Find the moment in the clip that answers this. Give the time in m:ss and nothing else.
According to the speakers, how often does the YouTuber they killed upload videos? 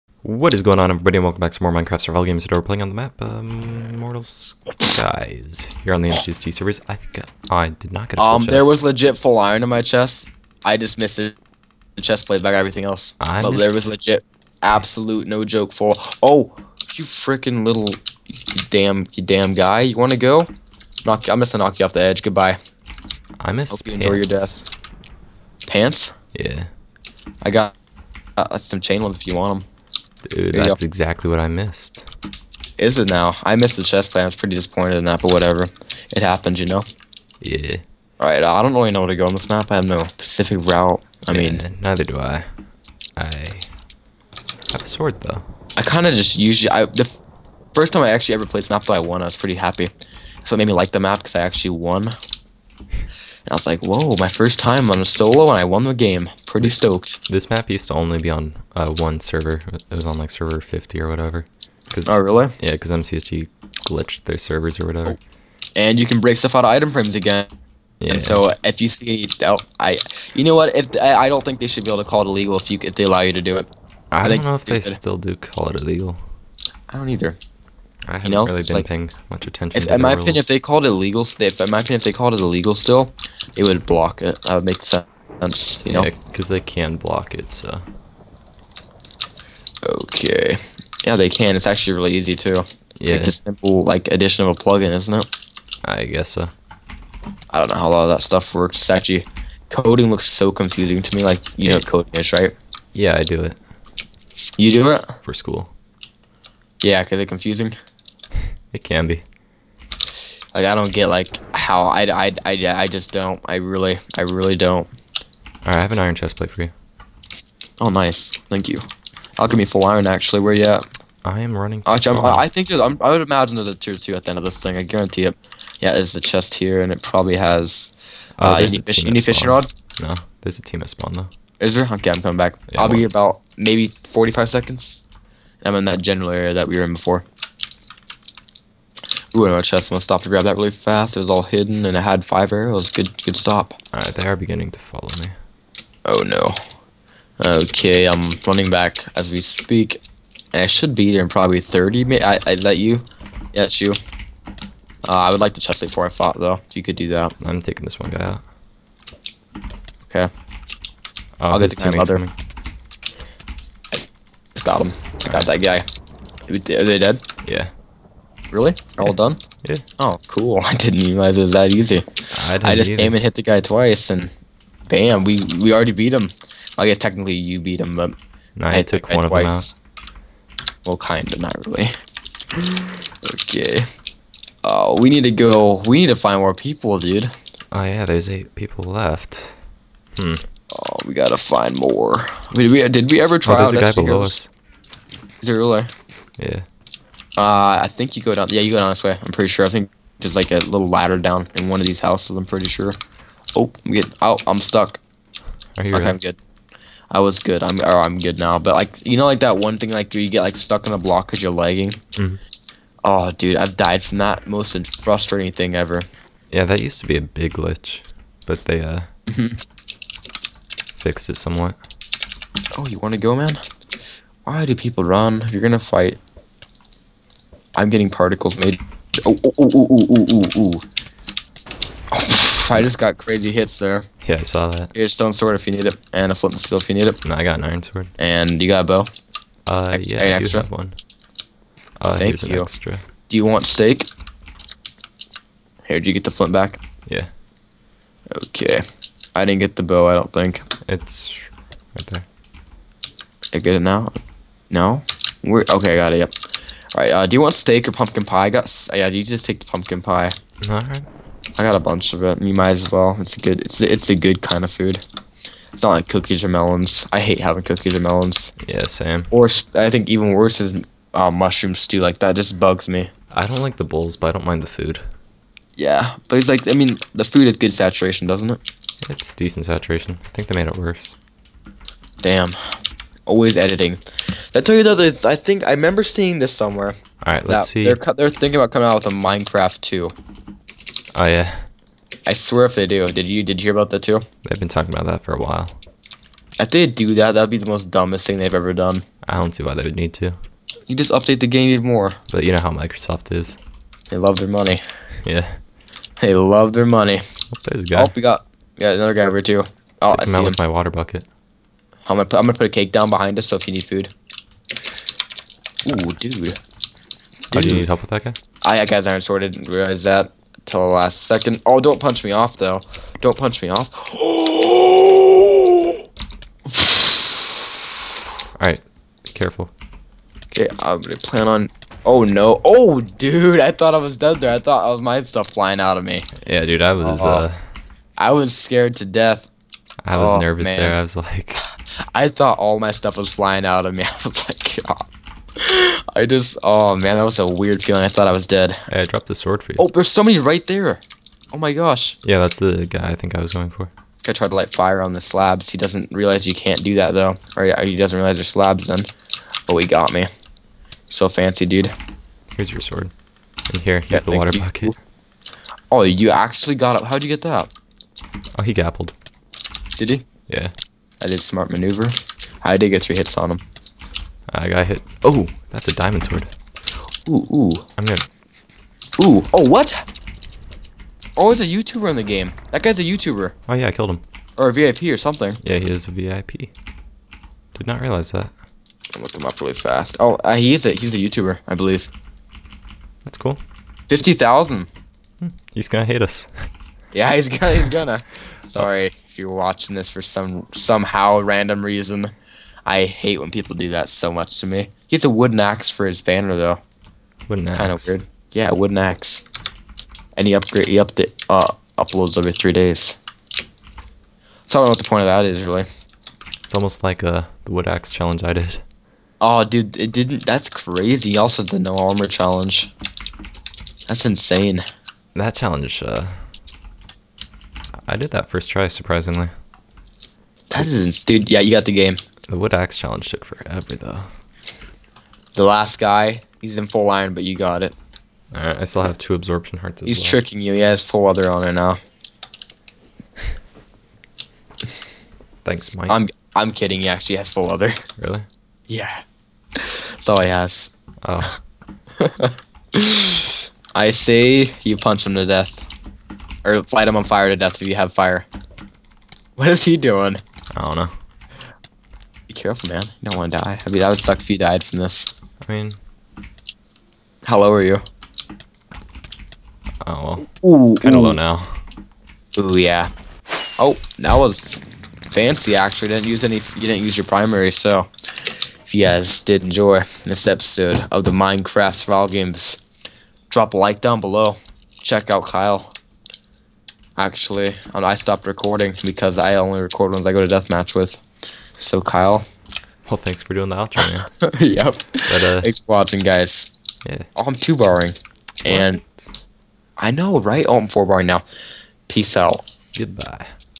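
6:52.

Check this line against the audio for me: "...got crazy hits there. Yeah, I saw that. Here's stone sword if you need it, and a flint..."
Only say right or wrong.
right.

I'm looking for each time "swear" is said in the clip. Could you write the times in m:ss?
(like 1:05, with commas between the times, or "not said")
4:52.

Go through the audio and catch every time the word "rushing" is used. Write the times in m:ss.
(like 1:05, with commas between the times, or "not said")
not said.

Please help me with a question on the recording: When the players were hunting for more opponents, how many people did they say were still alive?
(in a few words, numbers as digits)
8.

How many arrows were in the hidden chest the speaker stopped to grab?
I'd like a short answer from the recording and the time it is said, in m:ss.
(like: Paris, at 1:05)
5, at 2:22.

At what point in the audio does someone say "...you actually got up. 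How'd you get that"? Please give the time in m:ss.
6:06.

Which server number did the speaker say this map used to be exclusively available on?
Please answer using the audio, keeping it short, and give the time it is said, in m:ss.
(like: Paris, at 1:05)
50, at 1:00.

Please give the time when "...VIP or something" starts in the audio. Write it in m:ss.
6:24.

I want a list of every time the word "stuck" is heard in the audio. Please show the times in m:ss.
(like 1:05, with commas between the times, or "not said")
3:24, 3:30.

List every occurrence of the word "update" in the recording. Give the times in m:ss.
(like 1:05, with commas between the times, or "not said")
5:01, 6:50.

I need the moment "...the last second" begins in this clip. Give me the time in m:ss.
5:20.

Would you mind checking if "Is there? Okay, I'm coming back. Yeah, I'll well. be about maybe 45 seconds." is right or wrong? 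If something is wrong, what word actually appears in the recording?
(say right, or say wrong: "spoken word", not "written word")
right.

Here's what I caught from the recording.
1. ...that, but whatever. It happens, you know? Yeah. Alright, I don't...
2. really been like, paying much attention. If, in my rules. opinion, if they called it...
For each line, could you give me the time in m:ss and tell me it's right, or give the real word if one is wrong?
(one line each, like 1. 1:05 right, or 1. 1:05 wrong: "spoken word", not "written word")
1. 0:35 right
2. 1:18 right.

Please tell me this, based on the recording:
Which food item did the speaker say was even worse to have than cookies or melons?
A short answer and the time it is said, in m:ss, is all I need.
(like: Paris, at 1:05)
mushroom stew, at 4:31.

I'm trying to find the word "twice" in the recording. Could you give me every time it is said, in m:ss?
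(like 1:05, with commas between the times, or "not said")
2:53, 2:59.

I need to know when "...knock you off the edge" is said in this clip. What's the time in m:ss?
0:21.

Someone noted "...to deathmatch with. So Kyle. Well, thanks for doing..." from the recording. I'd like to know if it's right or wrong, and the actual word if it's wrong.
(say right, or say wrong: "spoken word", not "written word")
right.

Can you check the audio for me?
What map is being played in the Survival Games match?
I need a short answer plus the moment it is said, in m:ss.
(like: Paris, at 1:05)
Mortal Skies, at 0:03.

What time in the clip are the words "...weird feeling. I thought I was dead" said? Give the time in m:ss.
5:47.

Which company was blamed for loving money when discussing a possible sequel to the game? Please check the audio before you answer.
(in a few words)
Microsoft.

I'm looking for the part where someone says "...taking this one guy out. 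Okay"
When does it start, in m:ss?
2:37.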